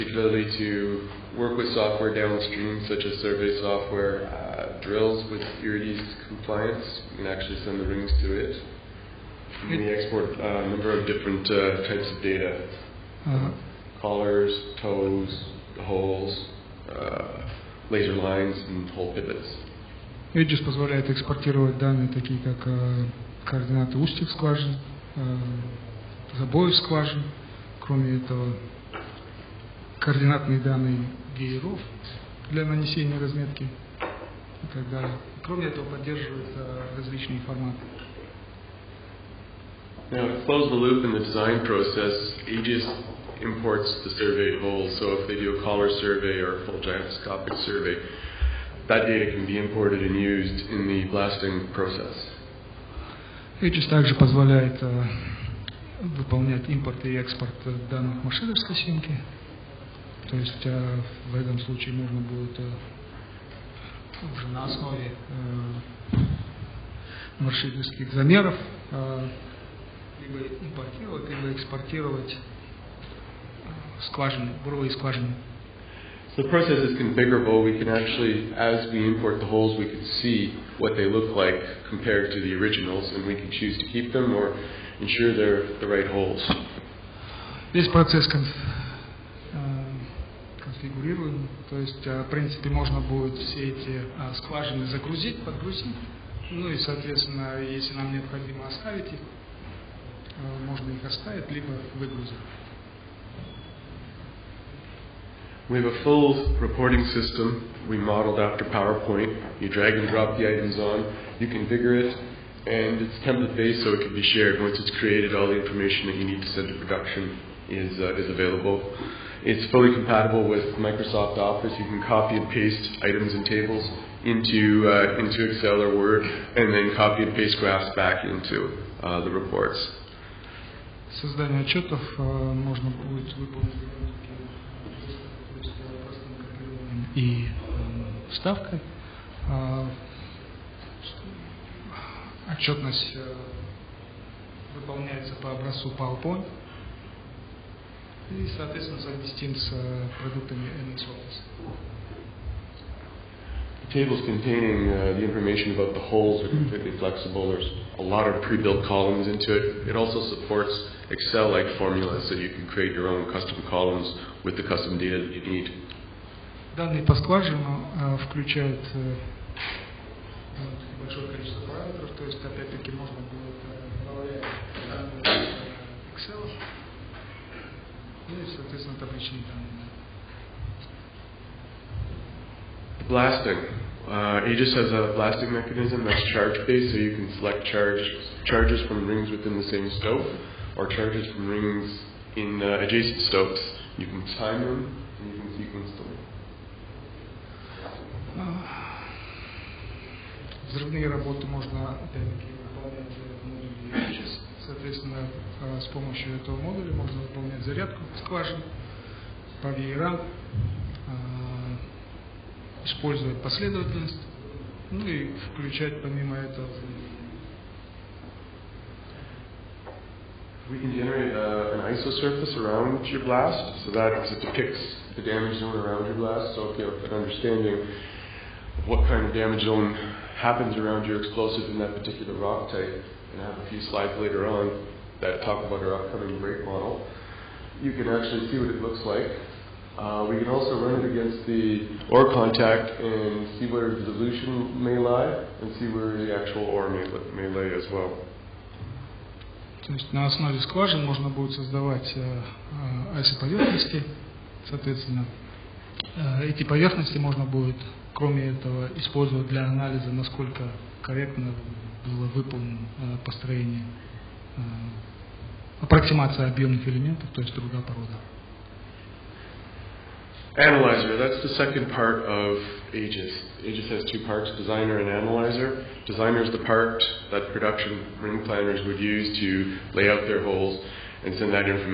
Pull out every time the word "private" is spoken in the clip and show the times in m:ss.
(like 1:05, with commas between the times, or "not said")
not said.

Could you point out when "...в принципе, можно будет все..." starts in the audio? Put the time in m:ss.
1:32.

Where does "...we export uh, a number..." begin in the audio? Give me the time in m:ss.
0:09.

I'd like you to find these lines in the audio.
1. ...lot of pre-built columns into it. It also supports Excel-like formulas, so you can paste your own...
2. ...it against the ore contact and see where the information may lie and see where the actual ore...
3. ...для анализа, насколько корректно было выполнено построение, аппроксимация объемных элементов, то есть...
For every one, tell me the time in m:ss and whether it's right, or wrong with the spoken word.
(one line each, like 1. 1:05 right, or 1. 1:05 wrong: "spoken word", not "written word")
1. 2:38 wrong: "create", not "paste"
2. 4:01 wrong: "dilution", not "information"
3. 4:19 right.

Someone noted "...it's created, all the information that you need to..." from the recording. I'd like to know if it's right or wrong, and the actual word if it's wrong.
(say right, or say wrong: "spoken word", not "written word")
right.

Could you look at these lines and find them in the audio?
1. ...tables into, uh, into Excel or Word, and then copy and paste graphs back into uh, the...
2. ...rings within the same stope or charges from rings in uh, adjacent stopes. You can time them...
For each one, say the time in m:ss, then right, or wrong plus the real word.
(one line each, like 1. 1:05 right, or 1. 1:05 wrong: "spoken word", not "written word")
1. 2:03 right
2. 3:09 right.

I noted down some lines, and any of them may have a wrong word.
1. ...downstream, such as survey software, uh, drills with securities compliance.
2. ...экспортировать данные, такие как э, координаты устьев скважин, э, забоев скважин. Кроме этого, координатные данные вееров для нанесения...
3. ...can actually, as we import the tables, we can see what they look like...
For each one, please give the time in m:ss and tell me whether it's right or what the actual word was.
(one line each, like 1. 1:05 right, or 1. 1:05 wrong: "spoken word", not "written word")
1. 0:02 right
2. 0:21 right
3. 1:17 wrong: "holes", not "tables".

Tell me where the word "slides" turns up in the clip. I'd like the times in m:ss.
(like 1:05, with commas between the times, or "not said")
3:53.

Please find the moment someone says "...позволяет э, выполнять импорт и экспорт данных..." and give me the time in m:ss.
0:54.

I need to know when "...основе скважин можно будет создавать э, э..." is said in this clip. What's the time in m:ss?
4:10.